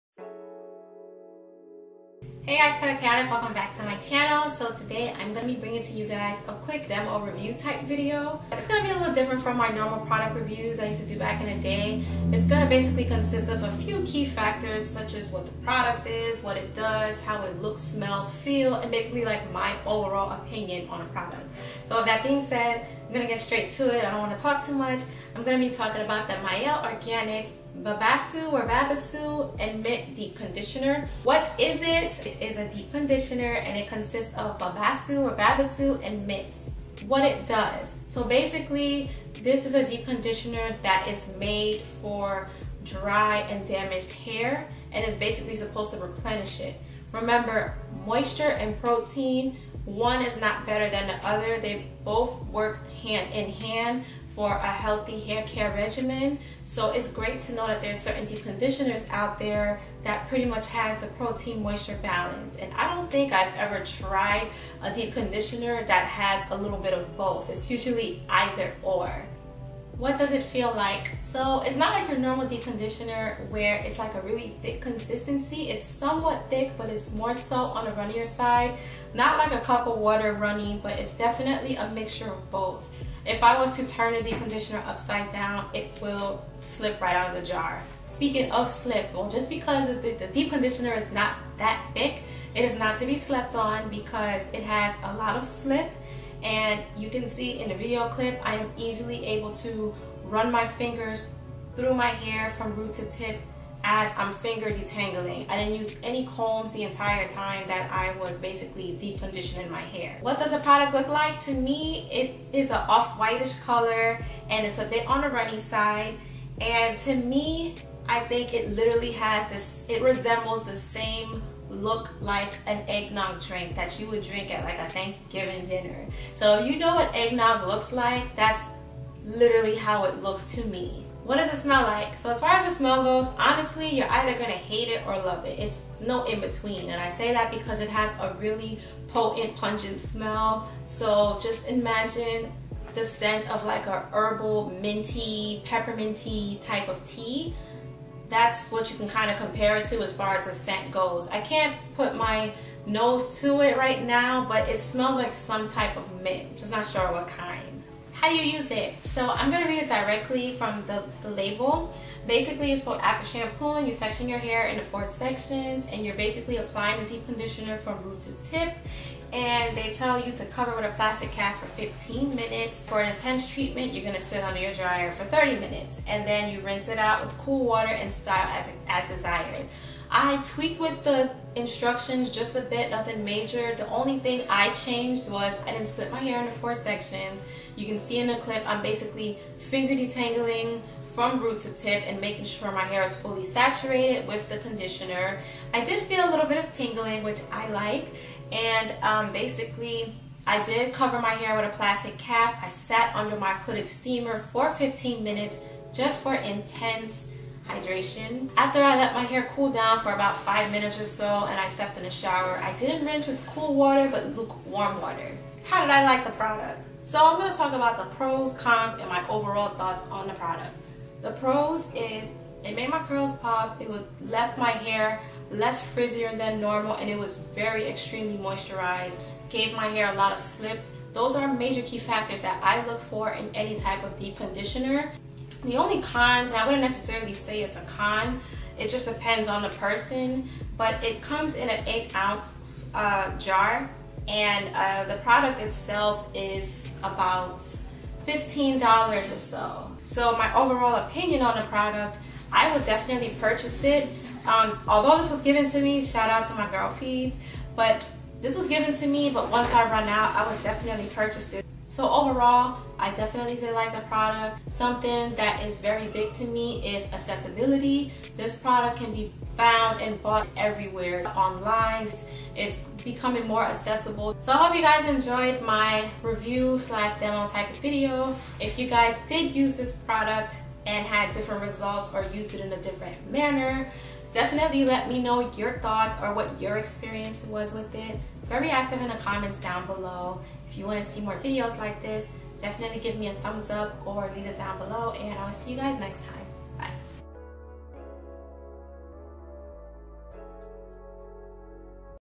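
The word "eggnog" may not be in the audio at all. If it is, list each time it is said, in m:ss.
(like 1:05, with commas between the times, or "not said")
2:02, 2:07.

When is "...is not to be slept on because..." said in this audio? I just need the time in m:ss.
1:32.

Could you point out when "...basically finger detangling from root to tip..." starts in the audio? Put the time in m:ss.
3:08.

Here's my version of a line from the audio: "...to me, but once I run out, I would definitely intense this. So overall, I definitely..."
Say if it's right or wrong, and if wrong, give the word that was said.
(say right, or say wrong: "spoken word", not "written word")
wrong: "purchase", not "intense".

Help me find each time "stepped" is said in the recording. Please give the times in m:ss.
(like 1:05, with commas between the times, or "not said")
3:31.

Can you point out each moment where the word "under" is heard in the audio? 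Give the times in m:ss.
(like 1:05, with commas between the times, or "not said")
2:54, 3:23.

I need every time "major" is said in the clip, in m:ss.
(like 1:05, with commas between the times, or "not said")
3:03, 3:51.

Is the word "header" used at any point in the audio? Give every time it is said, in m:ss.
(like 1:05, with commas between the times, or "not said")
not said.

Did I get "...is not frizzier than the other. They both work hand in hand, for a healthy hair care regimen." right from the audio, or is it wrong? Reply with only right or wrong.
wrong.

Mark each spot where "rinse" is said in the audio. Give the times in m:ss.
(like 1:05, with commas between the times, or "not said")
2:56, 3:33.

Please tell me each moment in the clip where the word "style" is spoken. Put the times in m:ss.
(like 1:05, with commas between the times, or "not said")
2:58.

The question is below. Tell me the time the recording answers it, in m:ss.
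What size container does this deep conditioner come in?
4:01.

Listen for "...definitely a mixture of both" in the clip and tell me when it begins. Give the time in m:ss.
1:21.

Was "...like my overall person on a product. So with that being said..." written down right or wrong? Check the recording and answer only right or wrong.
wrong.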